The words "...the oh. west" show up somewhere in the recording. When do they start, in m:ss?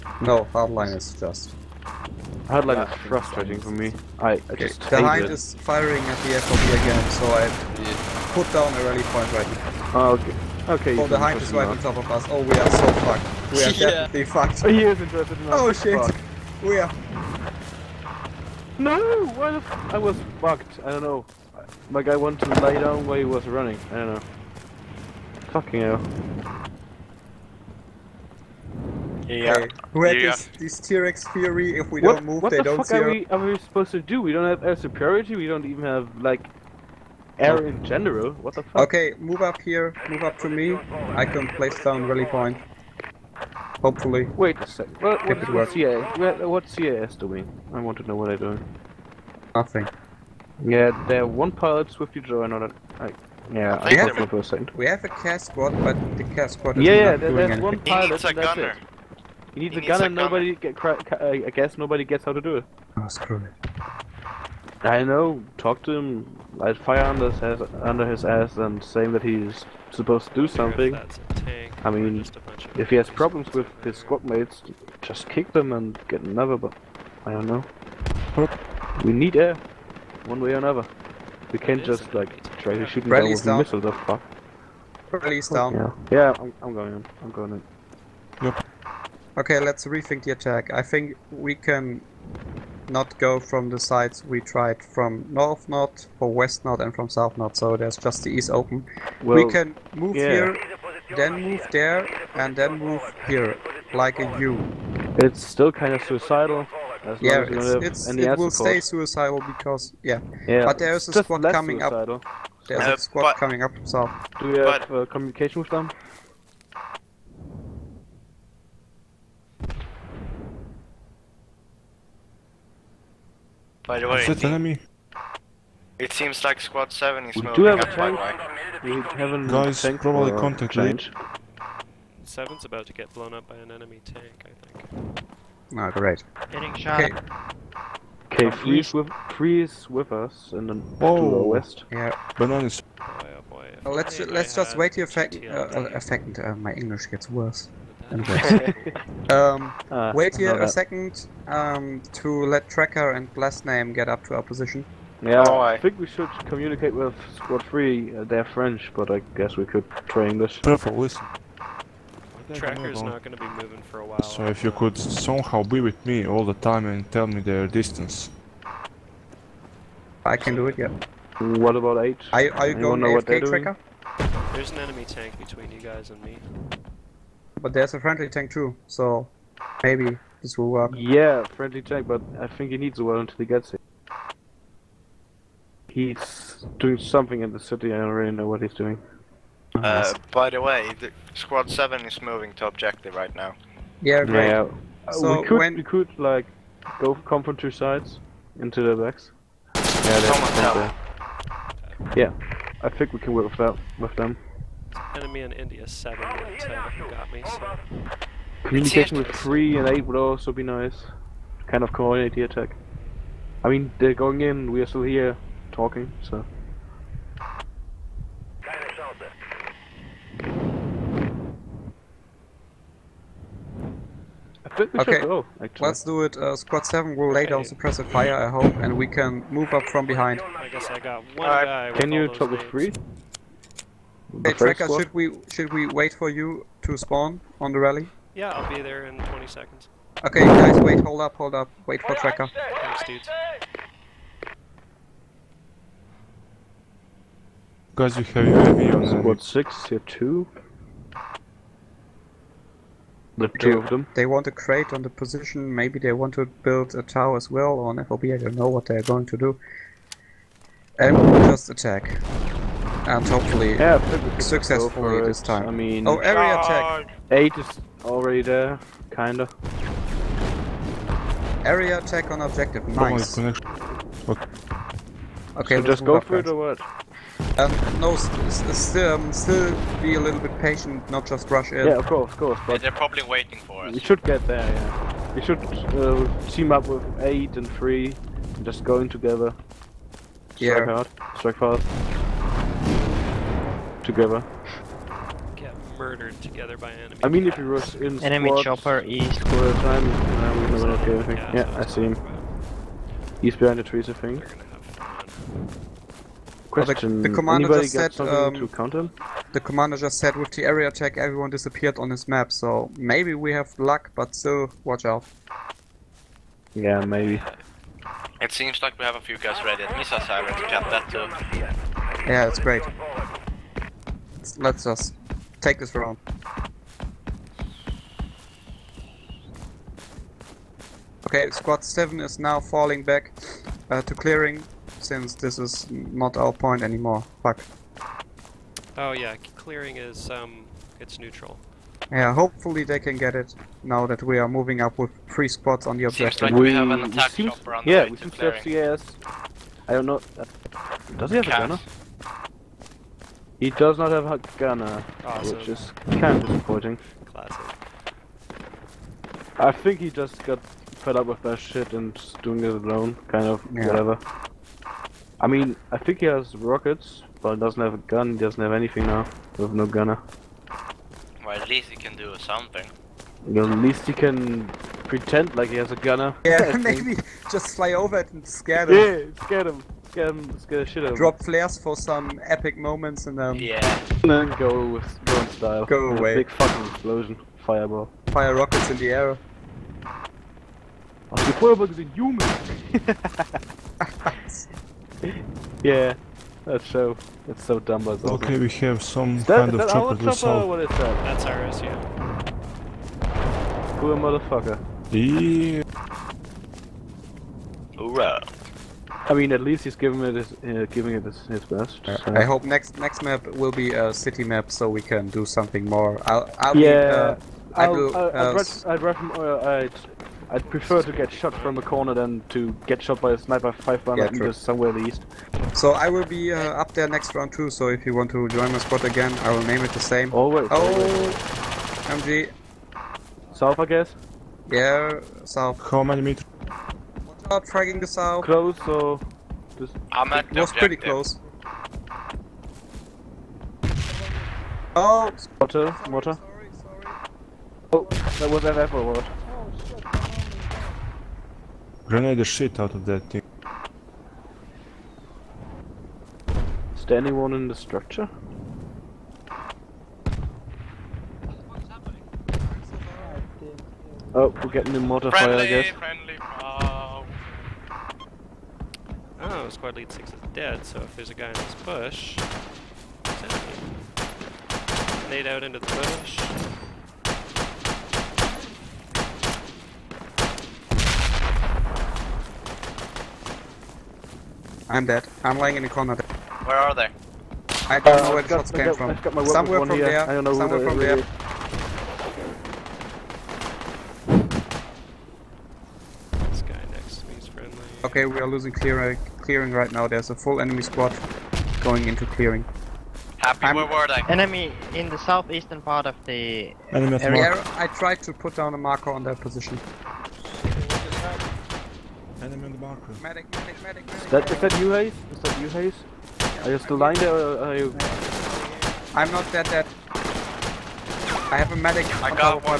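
2:21.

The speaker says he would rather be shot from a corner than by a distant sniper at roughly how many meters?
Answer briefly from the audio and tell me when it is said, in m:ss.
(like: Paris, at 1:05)
500, at 7:03.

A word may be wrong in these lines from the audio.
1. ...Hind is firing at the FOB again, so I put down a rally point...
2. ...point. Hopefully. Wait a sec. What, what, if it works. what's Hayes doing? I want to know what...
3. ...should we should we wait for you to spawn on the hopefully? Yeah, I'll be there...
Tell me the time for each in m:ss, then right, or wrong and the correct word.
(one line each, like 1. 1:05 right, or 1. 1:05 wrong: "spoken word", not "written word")
1. 0:04 right
2. 0:42 wrong: "CIS", not "Hayes"
3. 3:55 wrong: "rally", not "hopefully".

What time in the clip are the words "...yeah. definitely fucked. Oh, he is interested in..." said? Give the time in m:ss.
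0:13.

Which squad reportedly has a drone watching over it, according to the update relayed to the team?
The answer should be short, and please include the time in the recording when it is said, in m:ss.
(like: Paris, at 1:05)
Squad 6, at 4:08.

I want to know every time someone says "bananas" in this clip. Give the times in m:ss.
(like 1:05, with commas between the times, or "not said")
2:22.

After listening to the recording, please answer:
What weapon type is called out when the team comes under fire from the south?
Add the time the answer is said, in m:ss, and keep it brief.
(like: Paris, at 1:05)
MG, at 7:12.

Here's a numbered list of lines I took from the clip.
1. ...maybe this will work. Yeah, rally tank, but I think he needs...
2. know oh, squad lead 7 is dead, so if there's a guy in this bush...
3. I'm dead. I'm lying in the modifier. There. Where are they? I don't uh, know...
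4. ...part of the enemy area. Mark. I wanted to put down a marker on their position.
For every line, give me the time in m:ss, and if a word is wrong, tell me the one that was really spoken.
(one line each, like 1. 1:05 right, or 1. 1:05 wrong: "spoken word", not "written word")
1. 2:59 wrong: "friendly", not "rally"
2. 7:49 wrong: "6", not "7"
3. 8:04 wrong: "corner", not "modifier"
4. 8:25 wrong: "tried", not "wanted".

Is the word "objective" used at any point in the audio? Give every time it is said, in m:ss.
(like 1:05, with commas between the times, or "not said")
3:12, 4:32, 5:46.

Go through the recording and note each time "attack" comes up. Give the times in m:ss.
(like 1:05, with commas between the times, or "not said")
1:30, 3:32, 4:21, 4:26, 4:31, 5:10, 5:47.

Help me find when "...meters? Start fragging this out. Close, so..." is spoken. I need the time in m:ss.
7:16.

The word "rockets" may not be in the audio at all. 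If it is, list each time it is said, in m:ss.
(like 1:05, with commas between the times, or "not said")
6:06, 6:28.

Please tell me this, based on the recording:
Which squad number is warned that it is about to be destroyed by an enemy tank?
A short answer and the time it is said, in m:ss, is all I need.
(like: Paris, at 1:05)
7, at 2:12.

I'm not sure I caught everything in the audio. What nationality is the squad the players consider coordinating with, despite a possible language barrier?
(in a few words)
French.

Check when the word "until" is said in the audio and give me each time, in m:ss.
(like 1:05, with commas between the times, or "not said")
3:03.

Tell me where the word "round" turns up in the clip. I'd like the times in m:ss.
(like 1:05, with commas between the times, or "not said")
5:25, 7:07.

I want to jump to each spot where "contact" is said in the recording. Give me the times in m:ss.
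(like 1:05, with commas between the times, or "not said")
2:10.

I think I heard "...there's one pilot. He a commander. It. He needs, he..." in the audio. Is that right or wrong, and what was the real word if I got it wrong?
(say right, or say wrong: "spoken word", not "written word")
wrong: "gunner", not "commander".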